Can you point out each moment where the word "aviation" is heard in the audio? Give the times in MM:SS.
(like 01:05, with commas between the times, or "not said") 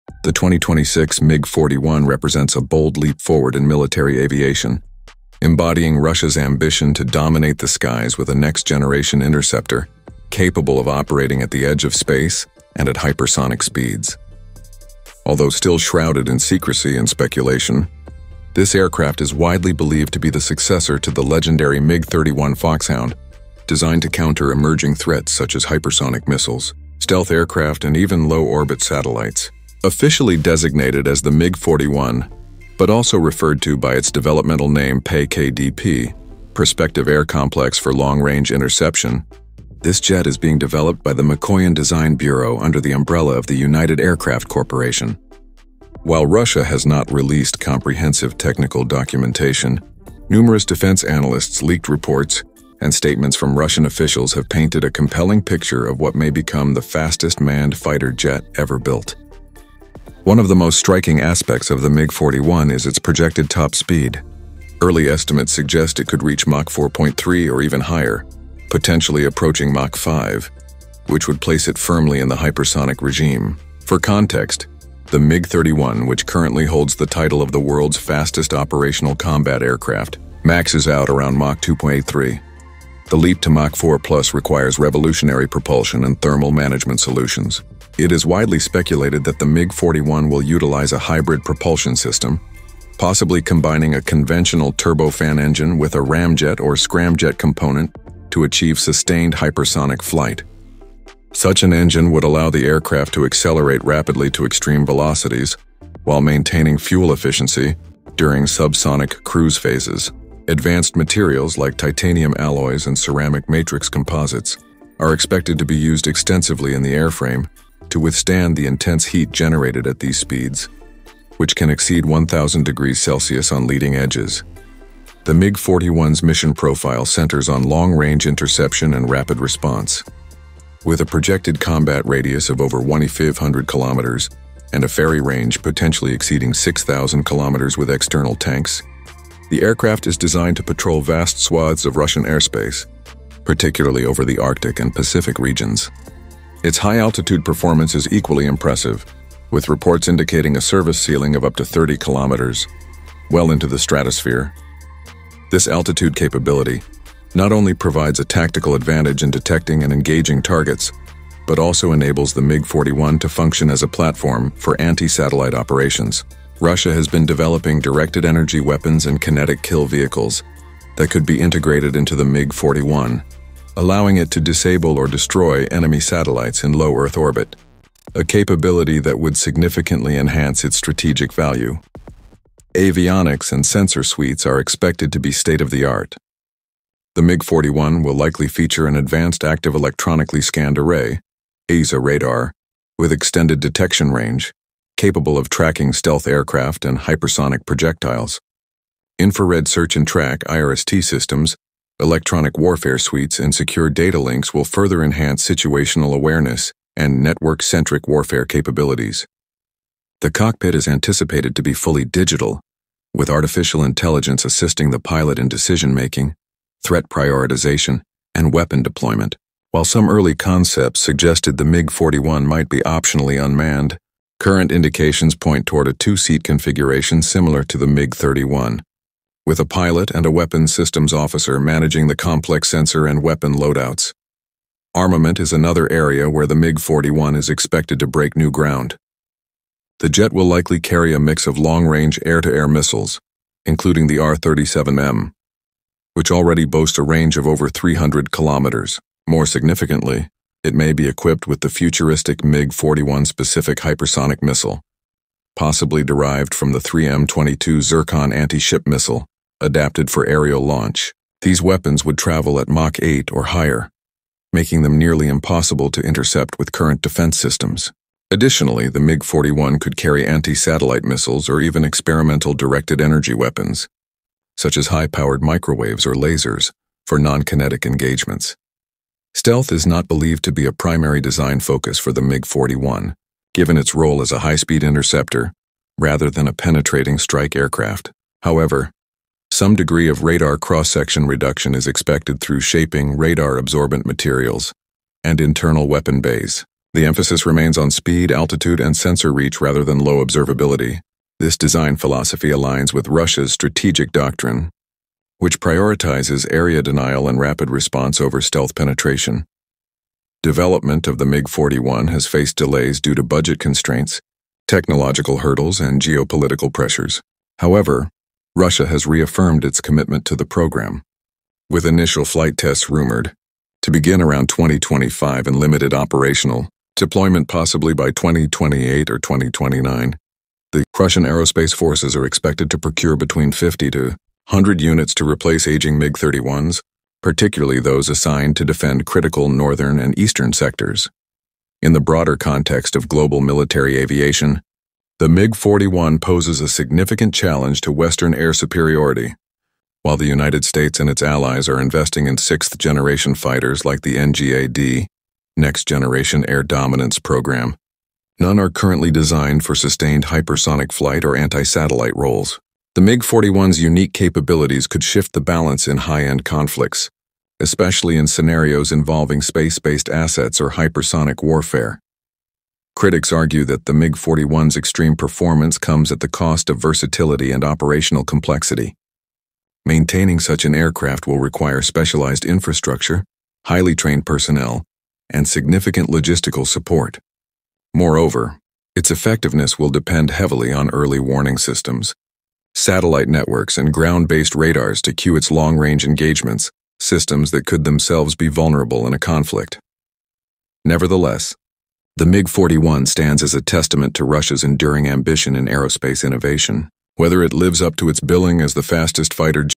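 00:04, 05:43.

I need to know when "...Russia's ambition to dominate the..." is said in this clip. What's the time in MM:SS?
00:05.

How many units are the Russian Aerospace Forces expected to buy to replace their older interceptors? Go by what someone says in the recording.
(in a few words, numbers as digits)
50 to 100.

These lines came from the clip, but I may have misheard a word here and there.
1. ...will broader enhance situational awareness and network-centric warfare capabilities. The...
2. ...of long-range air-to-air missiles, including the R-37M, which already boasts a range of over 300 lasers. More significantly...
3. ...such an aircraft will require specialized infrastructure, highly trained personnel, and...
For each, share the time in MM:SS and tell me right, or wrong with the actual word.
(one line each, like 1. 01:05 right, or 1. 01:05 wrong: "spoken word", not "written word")
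1. 03:24 wrong: "further", not "broader"
2. 04:01 wrong: "kilometers", not "lasers"
3. 06:20 right.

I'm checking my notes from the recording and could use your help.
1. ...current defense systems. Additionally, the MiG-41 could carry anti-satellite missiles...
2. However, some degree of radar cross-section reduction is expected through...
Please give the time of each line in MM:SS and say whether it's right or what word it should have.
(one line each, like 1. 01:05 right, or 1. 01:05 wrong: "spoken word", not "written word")
1. 04:26 right
2. 04:48 right.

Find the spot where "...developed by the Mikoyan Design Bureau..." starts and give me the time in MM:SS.
00:40.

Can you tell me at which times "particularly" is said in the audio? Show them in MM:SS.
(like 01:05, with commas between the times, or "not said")
02:23, 05:37.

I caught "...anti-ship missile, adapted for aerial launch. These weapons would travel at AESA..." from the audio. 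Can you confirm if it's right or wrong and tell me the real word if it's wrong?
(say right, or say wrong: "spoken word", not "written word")
wrong: "Mach", not "AESA".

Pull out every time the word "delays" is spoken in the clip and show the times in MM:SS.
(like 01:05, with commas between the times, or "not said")
05:12.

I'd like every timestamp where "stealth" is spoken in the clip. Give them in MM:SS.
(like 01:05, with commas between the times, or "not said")
00:26, 03:15, 04:39, 05:08.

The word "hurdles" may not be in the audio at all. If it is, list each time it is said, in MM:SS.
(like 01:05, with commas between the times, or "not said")
05:15.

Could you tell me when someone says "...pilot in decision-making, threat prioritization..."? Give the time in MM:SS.
03:34.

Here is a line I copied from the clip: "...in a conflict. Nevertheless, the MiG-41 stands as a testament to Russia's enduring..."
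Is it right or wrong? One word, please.
right.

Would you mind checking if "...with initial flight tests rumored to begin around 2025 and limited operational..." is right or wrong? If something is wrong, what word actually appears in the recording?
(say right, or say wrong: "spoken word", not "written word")
right.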